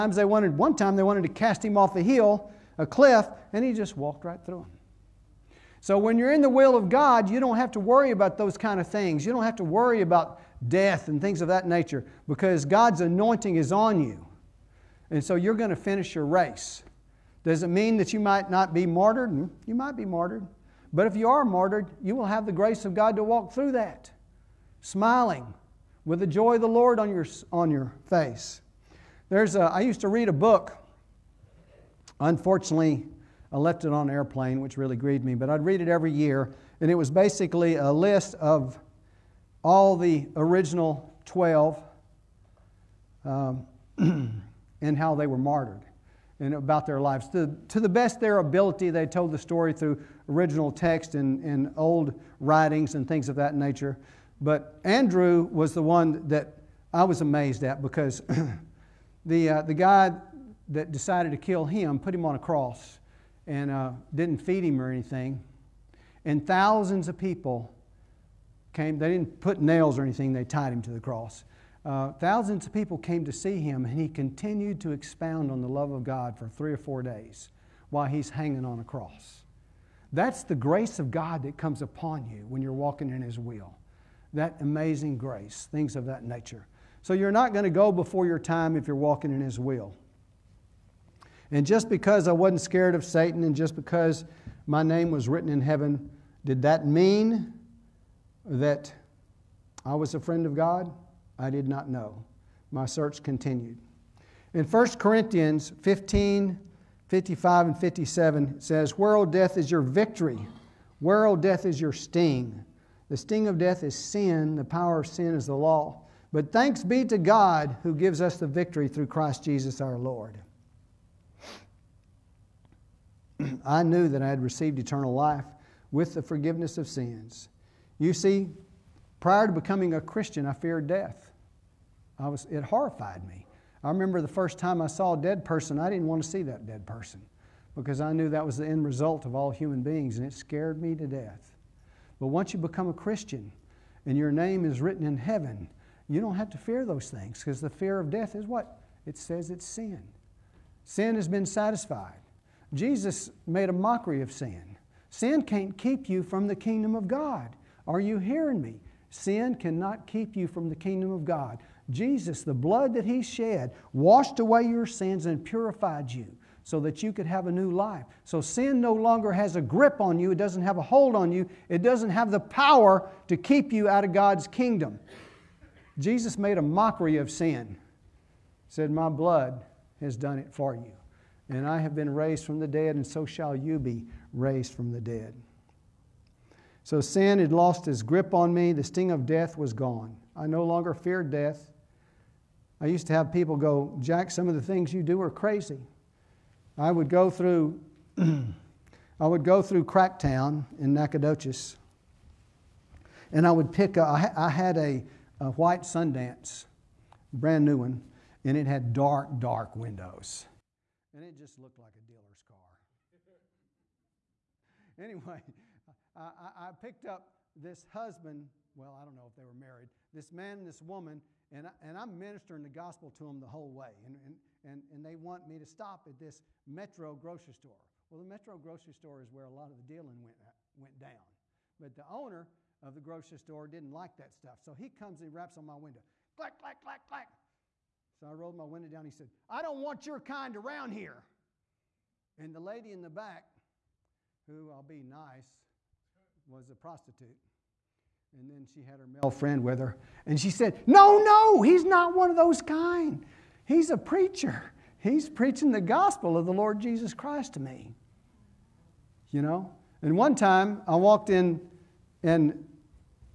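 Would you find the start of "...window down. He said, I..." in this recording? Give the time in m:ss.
3:58.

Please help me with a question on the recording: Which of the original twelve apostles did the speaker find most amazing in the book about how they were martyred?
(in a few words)
Andrew.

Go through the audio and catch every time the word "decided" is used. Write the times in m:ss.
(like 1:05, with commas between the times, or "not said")
1:00.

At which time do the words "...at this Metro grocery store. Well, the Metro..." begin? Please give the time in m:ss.
3:46.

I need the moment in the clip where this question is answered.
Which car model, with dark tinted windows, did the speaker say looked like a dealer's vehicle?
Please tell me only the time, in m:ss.
3:25.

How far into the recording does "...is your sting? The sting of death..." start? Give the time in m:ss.
1:51.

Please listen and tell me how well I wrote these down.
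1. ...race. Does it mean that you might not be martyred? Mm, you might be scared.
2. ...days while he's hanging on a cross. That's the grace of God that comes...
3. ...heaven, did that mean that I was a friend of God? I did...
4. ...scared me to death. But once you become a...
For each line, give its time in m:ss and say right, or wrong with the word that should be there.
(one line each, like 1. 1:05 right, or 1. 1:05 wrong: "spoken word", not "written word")
1. 0:16 wrong: "martyred", not "scared"
2. 1:17 right
3. 1:35 right
4. 2:20 right.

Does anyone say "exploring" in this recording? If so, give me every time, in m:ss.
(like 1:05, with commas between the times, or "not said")
not said.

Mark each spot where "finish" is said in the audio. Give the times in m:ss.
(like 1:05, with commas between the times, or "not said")
0:15.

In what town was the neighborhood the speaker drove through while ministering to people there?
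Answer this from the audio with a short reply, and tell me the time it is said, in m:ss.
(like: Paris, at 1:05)
Nacogdoches, at 3:20.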